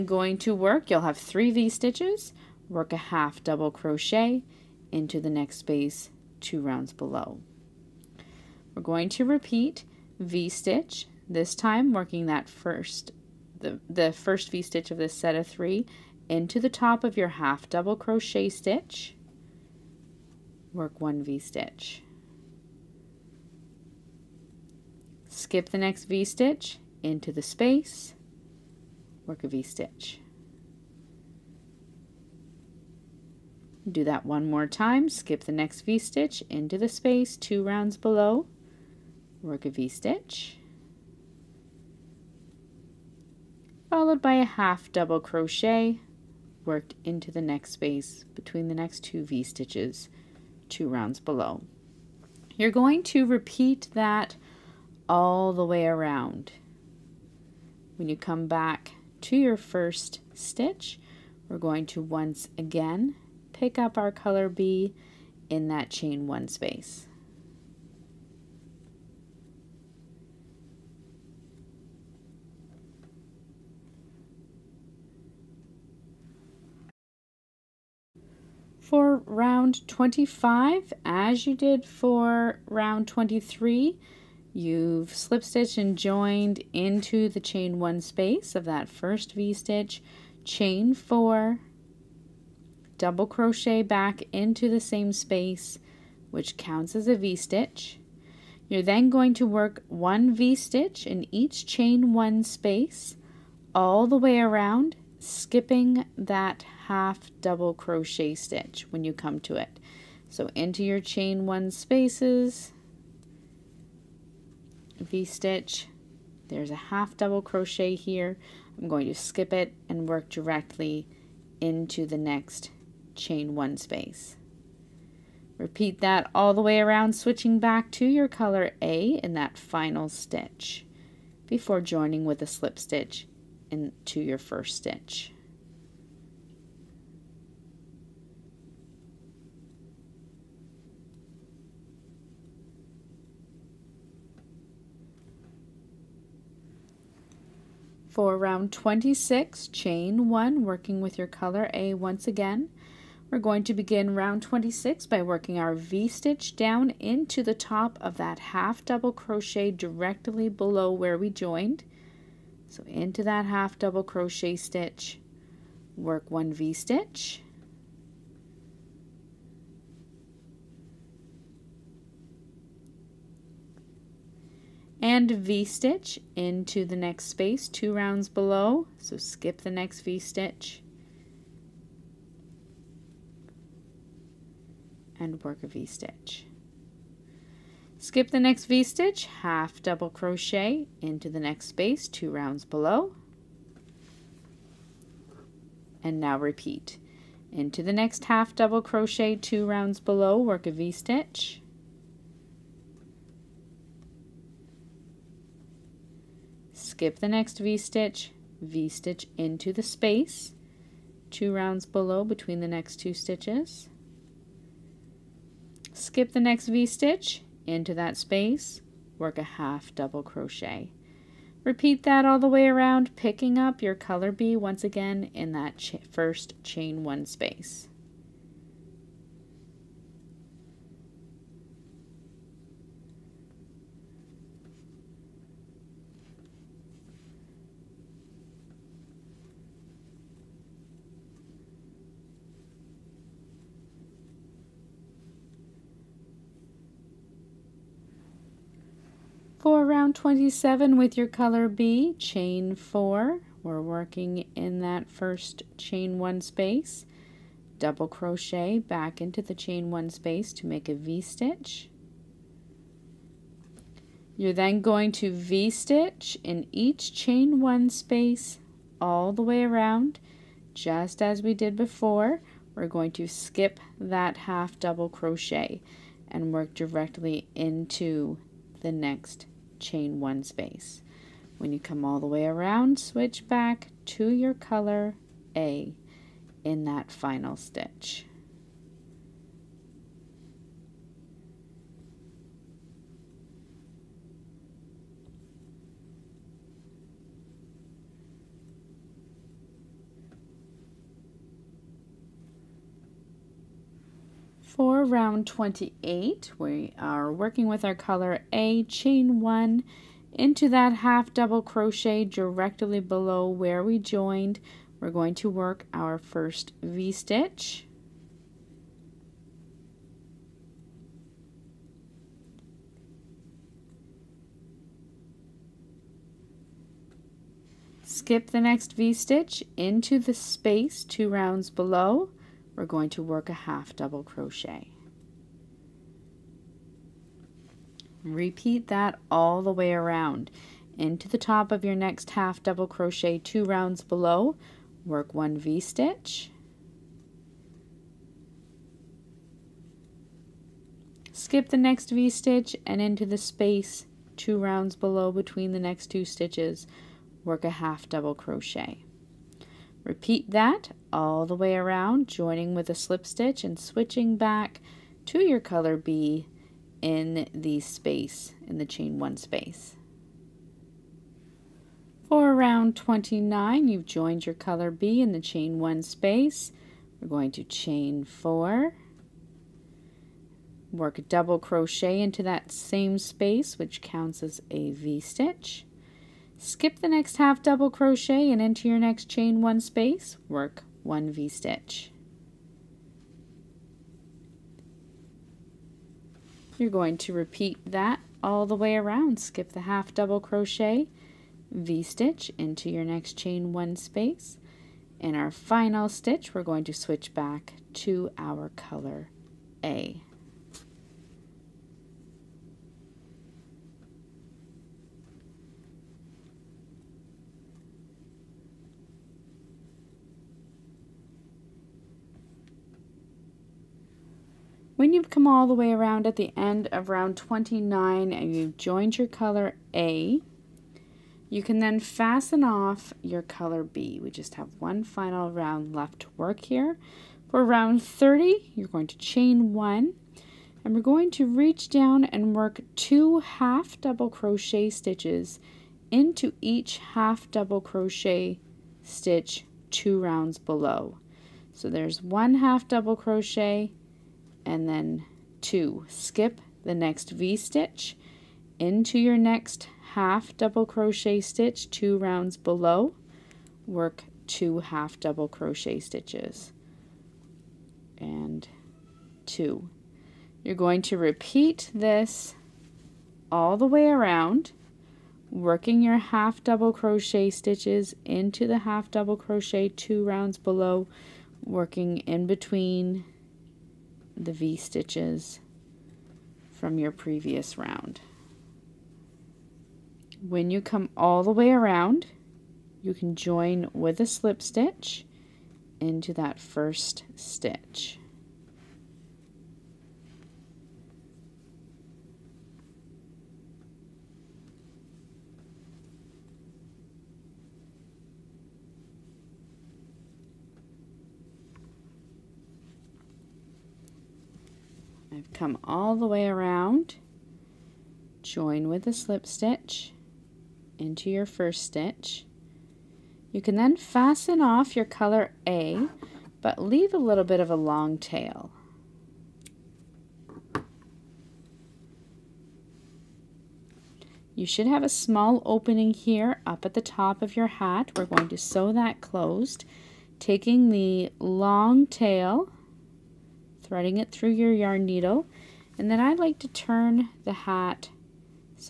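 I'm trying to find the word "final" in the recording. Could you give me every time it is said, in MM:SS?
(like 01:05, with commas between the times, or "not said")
02:09, 04:47, 06:45, 07:15.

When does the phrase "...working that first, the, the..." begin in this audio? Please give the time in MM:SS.
00:11.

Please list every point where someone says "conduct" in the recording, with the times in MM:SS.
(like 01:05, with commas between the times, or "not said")
not said.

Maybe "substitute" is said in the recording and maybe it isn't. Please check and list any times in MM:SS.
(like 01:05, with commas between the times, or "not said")
not said.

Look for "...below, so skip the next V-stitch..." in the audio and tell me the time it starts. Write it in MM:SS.
02:58.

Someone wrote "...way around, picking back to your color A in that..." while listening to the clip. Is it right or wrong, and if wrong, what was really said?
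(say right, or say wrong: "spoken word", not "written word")
wrong: "switching", not "picking".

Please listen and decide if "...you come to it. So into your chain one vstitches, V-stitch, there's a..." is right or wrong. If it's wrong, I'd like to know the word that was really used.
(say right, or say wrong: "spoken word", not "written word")
wrong: "spaces", not "vstitches".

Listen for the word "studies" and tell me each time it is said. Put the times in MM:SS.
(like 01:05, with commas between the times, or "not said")
not said.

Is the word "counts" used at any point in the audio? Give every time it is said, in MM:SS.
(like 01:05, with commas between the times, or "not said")
01:36, 06:24.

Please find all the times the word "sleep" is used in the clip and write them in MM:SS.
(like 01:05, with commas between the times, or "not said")
not said.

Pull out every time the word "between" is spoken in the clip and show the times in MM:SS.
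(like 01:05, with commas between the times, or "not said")
00:48, 03:32, 05:55, 08:02.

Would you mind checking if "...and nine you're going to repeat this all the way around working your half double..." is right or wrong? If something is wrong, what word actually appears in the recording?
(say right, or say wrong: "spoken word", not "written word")
wrong: "two", not "nine".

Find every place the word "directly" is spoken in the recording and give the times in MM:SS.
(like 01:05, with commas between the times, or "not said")
02:00, 02:39, 04:36, 05:12.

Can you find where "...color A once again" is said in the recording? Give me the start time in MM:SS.
02:31.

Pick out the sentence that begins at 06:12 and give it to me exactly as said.
For round 29, you've joined your color B in the chain one space.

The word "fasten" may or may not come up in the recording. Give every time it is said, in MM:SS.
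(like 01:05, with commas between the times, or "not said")
07:11, 08:43.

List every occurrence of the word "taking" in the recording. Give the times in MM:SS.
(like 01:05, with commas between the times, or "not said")
09:00.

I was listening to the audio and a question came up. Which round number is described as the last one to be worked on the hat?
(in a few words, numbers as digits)
30.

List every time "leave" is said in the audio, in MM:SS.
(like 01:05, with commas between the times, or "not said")
08:46.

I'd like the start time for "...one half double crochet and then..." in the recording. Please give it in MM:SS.
07:32.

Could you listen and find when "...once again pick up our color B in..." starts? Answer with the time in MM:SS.
01:02.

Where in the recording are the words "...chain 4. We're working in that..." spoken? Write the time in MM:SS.
04:12.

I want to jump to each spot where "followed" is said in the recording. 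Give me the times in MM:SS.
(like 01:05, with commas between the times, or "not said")
00:43.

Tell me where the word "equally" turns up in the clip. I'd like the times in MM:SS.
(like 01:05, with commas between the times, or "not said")
not said.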